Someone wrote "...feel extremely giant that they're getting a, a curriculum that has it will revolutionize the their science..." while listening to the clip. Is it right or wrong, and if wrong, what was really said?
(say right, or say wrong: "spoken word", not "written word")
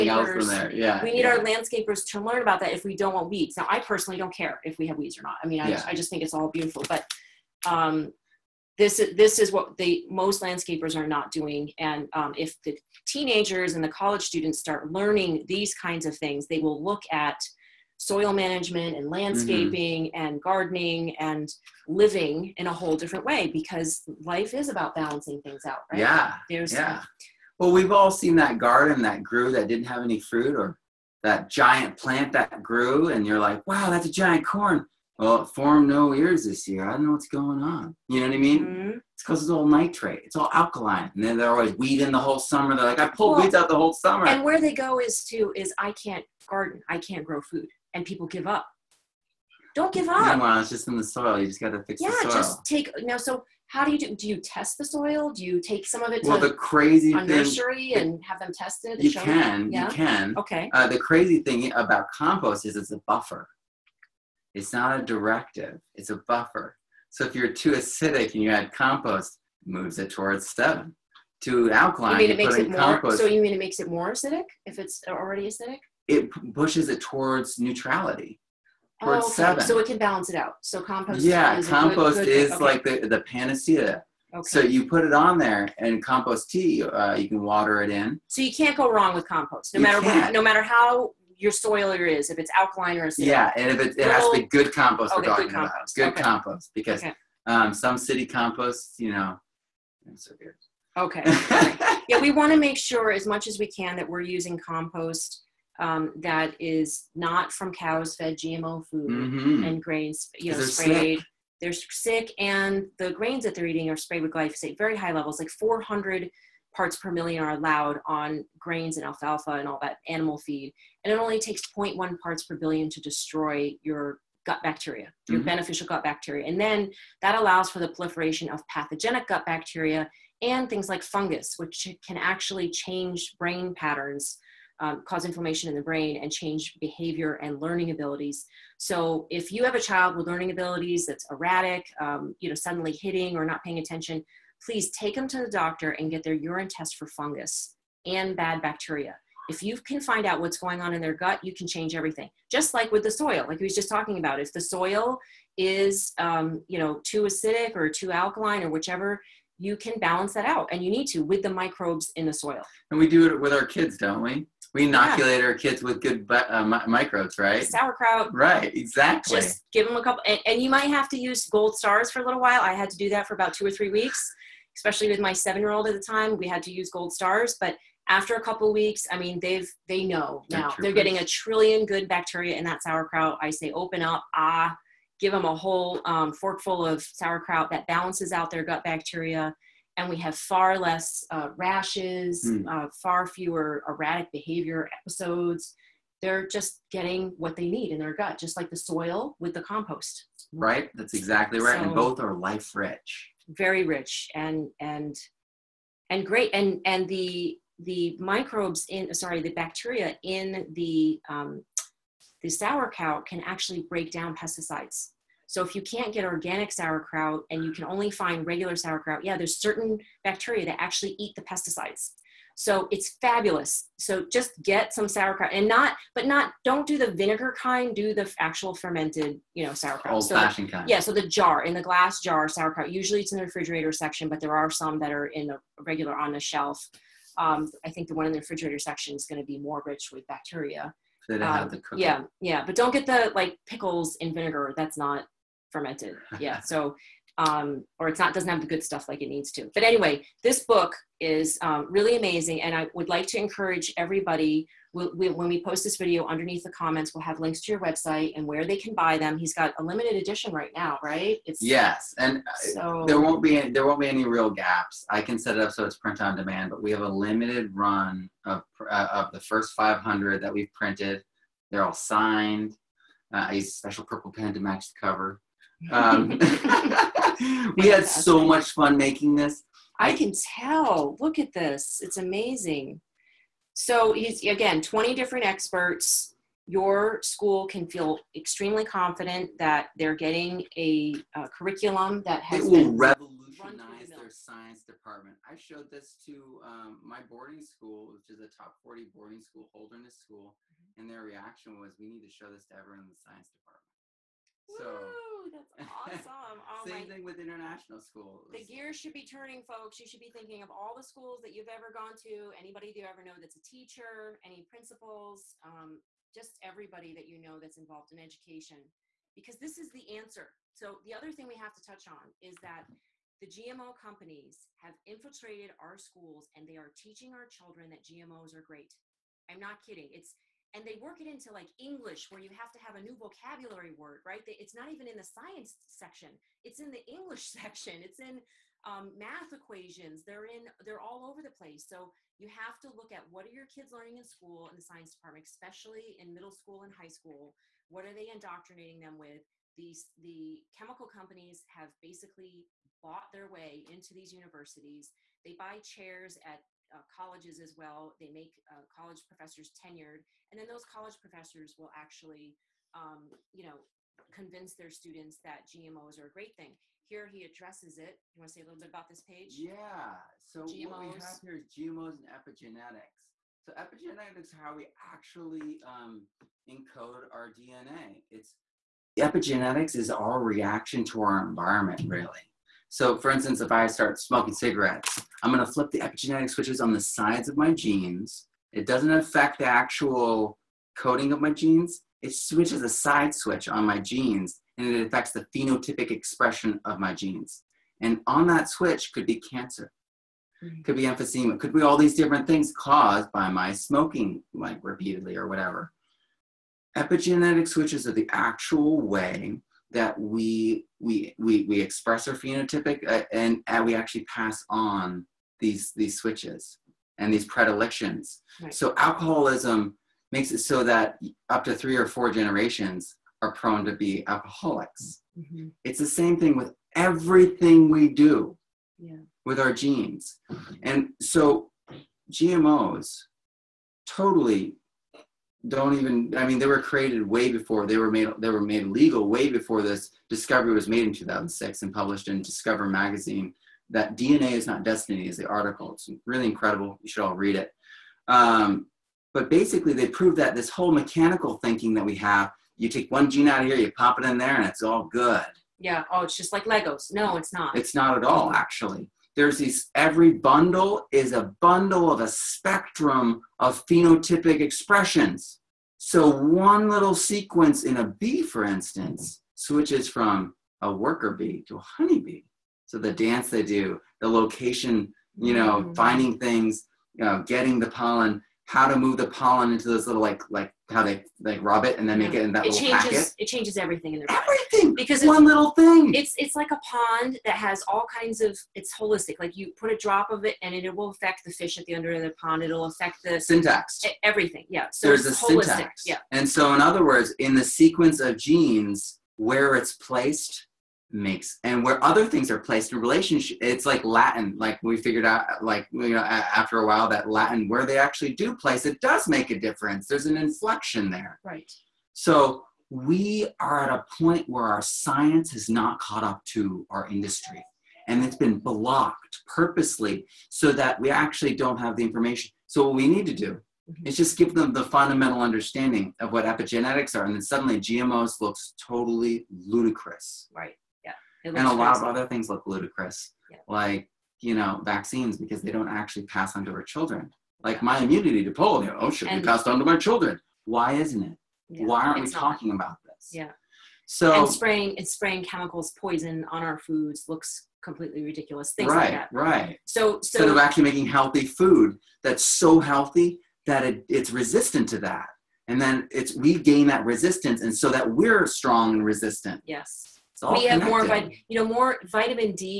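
wrong: "confident", not "giant".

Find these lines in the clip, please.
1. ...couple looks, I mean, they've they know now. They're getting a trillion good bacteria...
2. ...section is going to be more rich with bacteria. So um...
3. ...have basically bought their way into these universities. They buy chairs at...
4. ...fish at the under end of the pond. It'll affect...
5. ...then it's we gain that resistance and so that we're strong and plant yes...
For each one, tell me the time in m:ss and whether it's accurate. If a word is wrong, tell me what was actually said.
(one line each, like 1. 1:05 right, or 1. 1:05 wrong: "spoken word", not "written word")
1. 2:58 wrong: "weeks", not "looks"
2. 3:58 right
3. 5:51 right
4. 8:11 right
5. 9:15 wrong: "resistant", not "plant".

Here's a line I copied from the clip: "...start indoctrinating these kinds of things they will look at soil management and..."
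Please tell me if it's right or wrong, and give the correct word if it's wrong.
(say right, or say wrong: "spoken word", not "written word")
wrong: "learning", not "indoctrinating".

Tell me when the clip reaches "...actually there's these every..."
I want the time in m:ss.
7:38.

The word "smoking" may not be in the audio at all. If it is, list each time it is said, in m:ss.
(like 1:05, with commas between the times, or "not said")
6:24, 6:43.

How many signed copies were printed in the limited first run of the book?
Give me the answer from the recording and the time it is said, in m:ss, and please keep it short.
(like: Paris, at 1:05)
500, at 4:29.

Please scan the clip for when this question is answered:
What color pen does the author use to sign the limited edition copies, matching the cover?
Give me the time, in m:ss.
4:34.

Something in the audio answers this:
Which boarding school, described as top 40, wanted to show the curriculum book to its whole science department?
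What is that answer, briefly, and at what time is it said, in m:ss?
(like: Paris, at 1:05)
Holderness School, at 4:59.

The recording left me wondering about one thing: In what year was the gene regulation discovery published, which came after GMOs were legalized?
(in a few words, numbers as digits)
2006.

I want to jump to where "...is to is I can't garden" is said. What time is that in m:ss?
0:44.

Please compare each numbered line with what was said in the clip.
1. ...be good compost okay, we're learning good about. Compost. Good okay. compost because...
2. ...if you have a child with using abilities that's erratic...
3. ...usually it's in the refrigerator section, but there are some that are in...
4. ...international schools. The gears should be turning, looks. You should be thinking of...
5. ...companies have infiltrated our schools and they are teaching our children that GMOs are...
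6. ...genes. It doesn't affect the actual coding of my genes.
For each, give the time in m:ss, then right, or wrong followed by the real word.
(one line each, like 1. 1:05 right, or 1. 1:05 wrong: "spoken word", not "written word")
1. 1:34 wrong: "talking", not "learning"
2. 2:19 wrong: "learning", not "using"
3. 3:52 right
4. 5:07 wrong: "folks", not "looks"
5. 5:23 right
6. 6:27 right.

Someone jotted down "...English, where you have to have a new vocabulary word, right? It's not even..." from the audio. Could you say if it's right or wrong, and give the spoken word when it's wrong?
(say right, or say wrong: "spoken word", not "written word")
right.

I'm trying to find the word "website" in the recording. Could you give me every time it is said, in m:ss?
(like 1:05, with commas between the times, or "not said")
4:17.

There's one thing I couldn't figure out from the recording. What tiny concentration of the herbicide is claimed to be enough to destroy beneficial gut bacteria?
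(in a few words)
0.1 parts per billion.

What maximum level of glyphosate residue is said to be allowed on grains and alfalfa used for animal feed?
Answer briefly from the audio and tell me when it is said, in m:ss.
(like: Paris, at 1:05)
400 parts per million, at 1:55.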